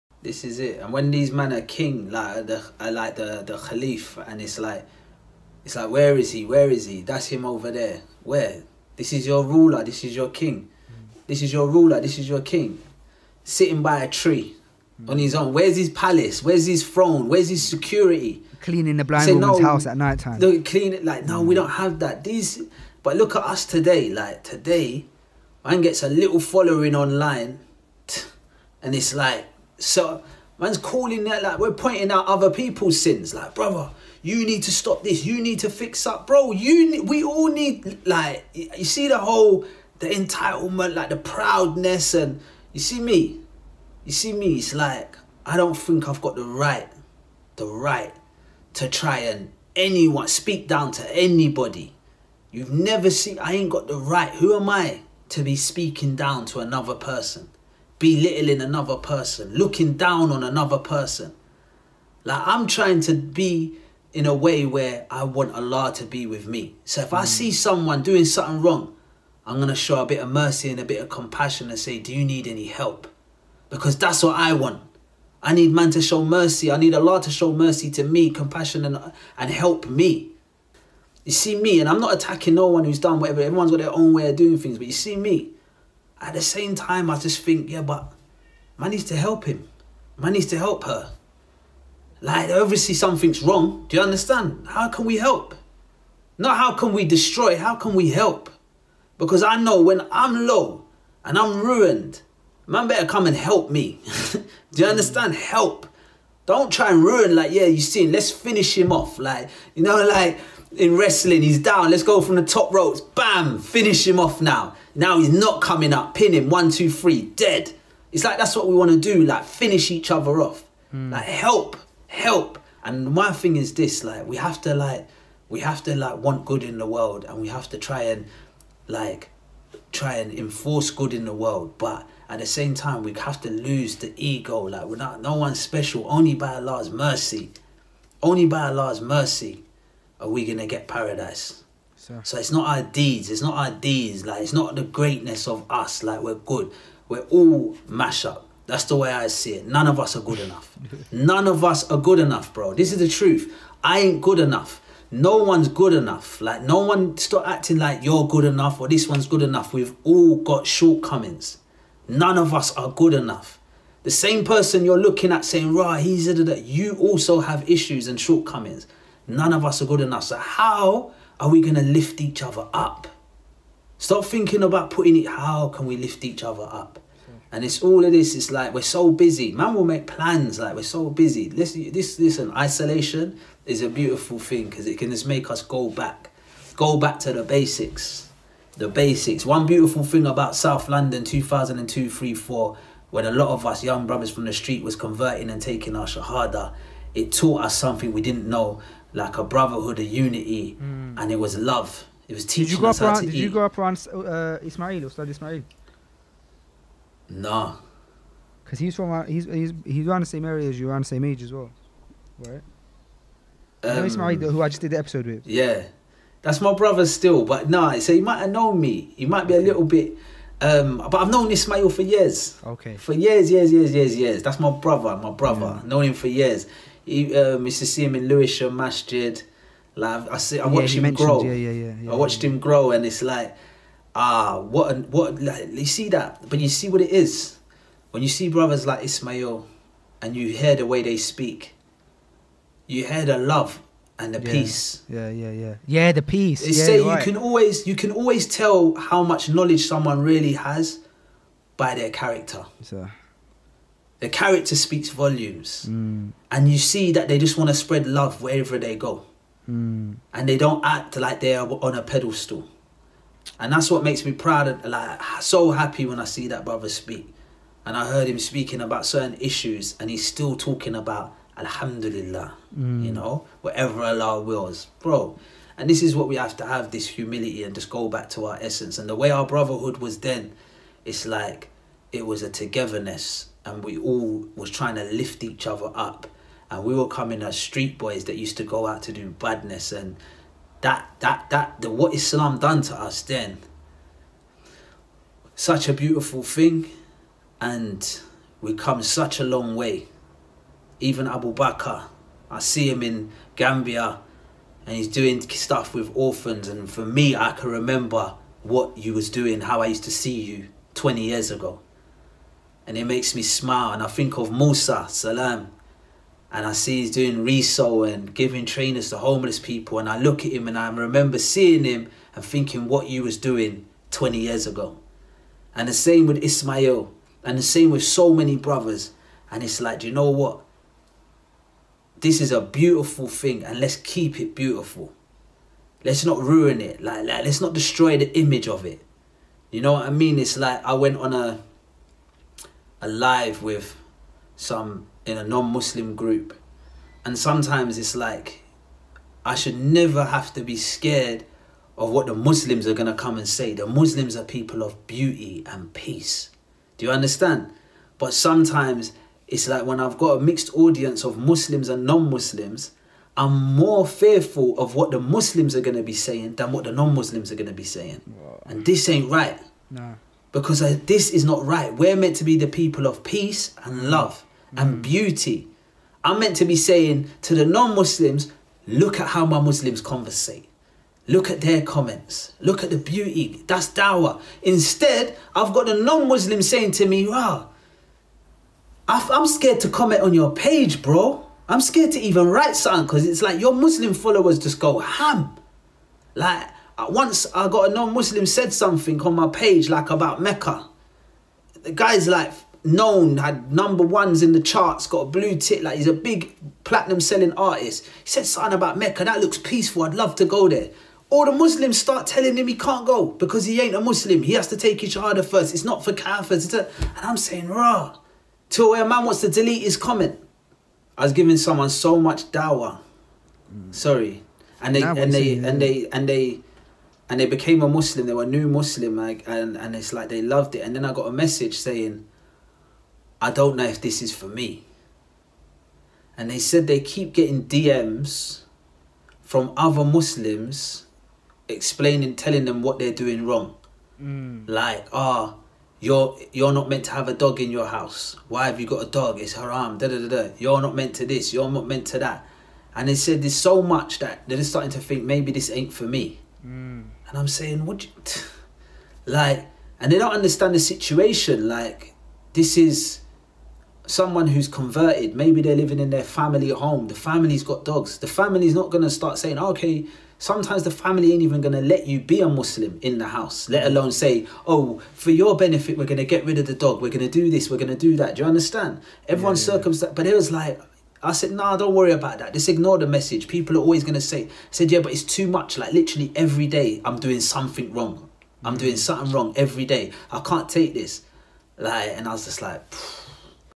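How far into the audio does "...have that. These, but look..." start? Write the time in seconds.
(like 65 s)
21 s.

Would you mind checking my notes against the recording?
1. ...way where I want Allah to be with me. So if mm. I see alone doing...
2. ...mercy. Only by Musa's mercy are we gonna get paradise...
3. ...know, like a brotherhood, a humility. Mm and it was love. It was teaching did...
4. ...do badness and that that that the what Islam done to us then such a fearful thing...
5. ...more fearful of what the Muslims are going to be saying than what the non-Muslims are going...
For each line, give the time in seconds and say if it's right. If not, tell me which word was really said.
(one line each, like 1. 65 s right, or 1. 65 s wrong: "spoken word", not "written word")
1. 64 s wrong: "someone", not "alone"
2. 136 s wrong: "Allah", not "Musa"
3. 198 s wrong: "unity", not "humility"
4. 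289 s wrong: "beautiful", not "fearful"
5. 363 s right.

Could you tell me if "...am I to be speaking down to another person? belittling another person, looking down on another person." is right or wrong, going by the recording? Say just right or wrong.
right.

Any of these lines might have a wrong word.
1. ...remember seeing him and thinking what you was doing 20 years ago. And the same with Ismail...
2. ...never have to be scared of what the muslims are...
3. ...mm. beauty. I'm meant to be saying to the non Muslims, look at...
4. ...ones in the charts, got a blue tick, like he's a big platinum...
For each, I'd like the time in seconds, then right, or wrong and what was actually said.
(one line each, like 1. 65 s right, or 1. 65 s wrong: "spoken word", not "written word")
1. 320 s right
2. 349 s right
3. 374 s right
4. 404 s right.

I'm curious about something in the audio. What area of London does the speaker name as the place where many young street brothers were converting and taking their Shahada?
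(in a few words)
South London.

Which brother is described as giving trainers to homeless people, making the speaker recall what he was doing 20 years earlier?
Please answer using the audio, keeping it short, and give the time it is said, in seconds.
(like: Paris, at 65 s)
Musa, at 314 s.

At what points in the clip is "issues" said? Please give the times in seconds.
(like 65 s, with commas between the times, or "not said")
167 s, 269 s.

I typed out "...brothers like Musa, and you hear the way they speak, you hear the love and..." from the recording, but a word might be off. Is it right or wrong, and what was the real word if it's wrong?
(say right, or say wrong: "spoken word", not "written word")
wrong: "Ismail", not "Musa".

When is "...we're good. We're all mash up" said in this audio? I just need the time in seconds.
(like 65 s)
146 s.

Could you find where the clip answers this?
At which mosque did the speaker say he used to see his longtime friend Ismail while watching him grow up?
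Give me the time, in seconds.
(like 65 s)
228 s.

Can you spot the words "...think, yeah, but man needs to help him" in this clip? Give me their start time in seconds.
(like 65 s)
87 s.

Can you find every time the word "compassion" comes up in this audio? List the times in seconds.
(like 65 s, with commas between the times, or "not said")
71 s, 78 s.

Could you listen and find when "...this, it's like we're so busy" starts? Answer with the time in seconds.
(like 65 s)
178 s.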